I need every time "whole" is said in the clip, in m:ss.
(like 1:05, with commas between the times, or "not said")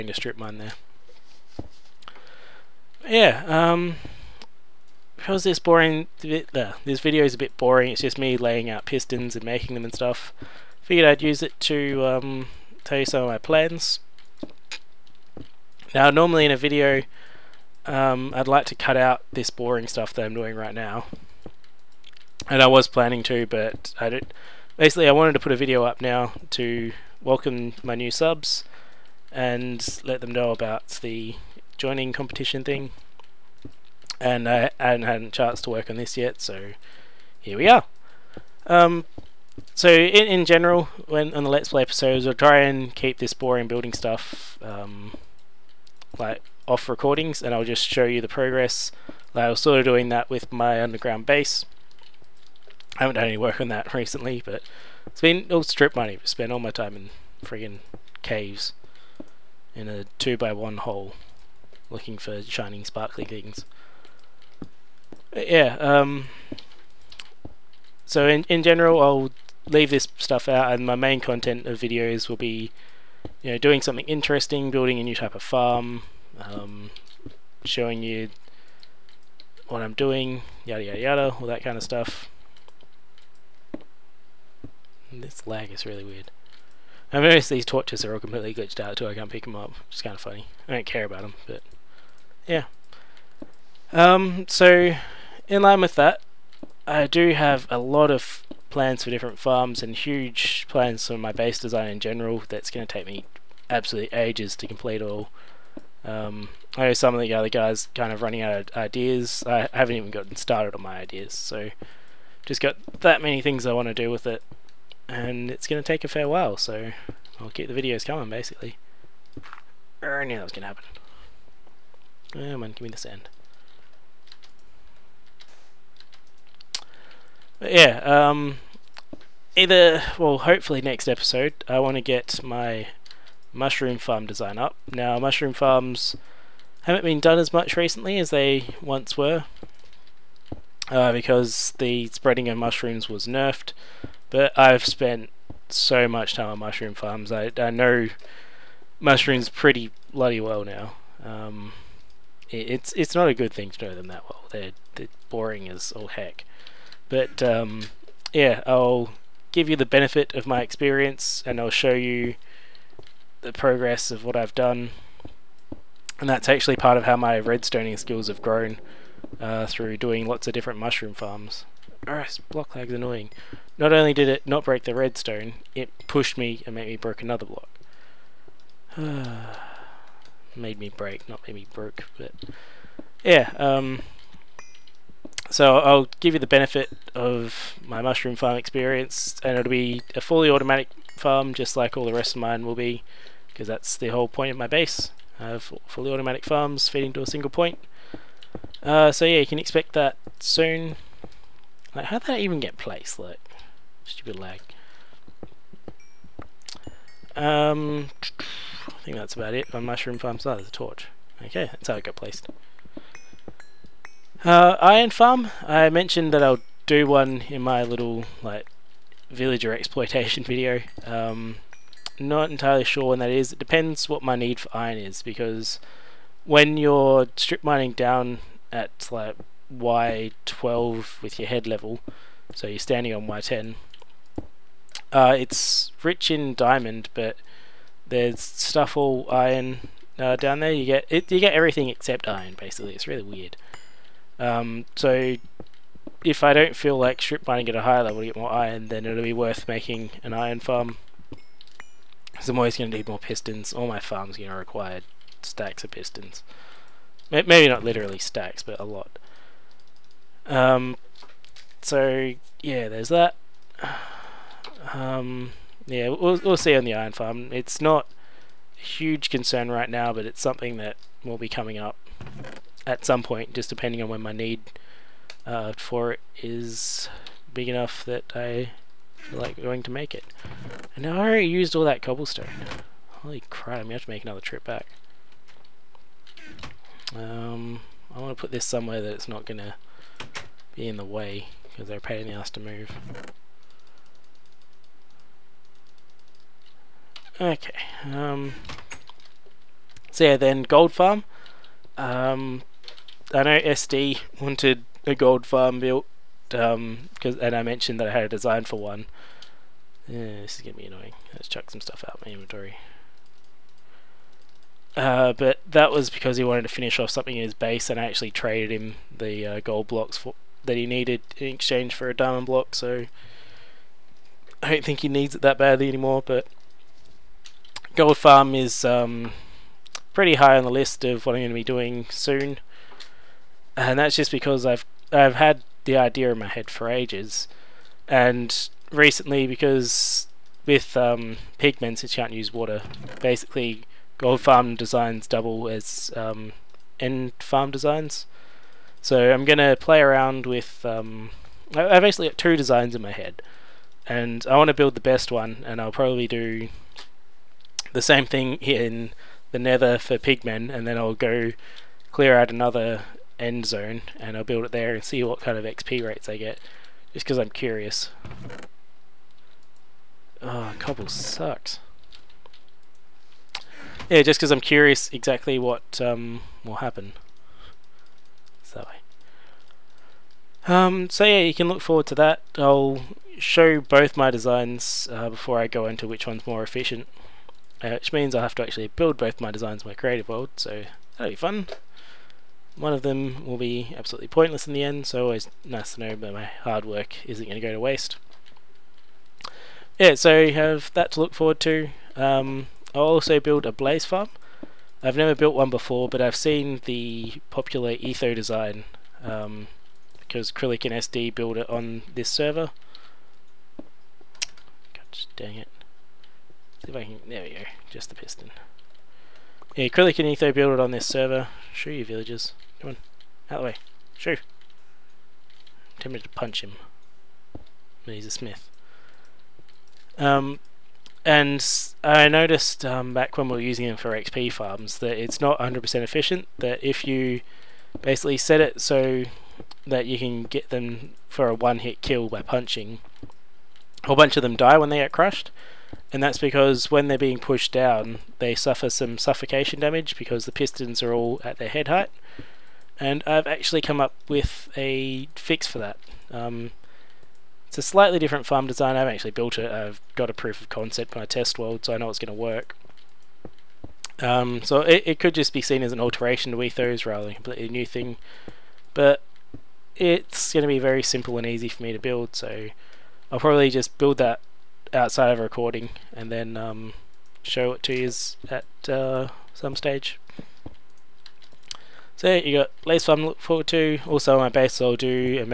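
3:14, 7:24.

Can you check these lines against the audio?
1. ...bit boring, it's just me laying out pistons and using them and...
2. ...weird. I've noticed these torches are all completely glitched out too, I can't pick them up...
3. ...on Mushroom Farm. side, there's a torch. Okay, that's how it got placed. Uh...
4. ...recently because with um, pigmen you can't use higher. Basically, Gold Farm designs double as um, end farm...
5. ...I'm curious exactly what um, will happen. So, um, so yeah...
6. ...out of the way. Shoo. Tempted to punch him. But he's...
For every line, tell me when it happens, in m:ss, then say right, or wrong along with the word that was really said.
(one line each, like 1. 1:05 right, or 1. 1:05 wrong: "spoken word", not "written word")
1. 0:07 wrong: "making", not "using"
2. 1:26 right
3. 3:29 right
4. 5:38 wrong: "water", not "higher"
5. 6:14 right
6. 7:03 right.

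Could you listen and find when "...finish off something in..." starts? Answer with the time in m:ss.
5:16.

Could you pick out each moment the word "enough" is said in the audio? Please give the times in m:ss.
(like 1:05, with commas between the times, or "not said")
4:37.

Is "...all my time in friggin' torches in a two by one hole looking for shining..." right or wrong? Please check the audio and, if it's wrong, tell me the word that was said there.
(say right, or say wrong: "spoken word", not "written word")
wrong: "caves", not "torches".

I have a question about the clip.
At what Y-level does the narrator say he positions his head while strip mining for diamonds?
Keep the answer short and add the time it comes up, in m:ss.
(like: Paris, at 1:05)
Y12, at 3:49.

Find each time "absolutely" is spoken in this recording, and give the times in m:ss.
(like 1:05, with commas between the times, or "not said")
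1:43, 6:33.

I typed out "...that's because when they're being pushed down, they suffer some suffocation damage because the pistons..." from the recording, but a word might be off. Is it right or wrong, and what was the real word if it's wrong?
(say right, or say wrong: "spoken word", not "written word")
right.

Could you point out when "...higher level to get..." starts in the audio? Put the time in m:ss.
4:07.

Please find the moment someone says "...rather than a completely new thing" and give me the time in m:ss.
7:47.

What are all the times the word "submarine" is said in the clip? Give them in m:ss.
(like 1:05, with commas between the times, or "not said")
not said.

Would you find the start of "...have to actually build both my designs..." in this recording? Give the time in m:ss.
6:28.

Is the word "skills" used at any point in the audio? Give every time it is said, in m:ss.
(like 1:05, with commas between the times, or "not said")
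2:47.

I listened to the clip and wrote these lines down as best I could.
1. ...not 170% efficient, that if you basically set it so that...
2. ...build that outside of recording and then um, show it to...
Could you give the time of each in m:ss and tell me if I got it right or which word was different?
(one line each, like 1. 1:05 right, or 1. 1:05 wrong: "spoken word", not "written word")
1. 7:15 wrong: "100", not "170"
2. 7:53 right.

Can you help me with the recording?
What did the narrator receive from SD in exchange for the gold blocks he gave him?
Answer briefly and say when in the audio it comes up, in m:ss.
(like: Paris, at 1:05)
a diamond block, at 5:22.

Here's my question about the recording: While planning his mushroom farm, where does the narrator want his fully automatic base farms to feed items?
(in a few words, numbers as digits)
single point.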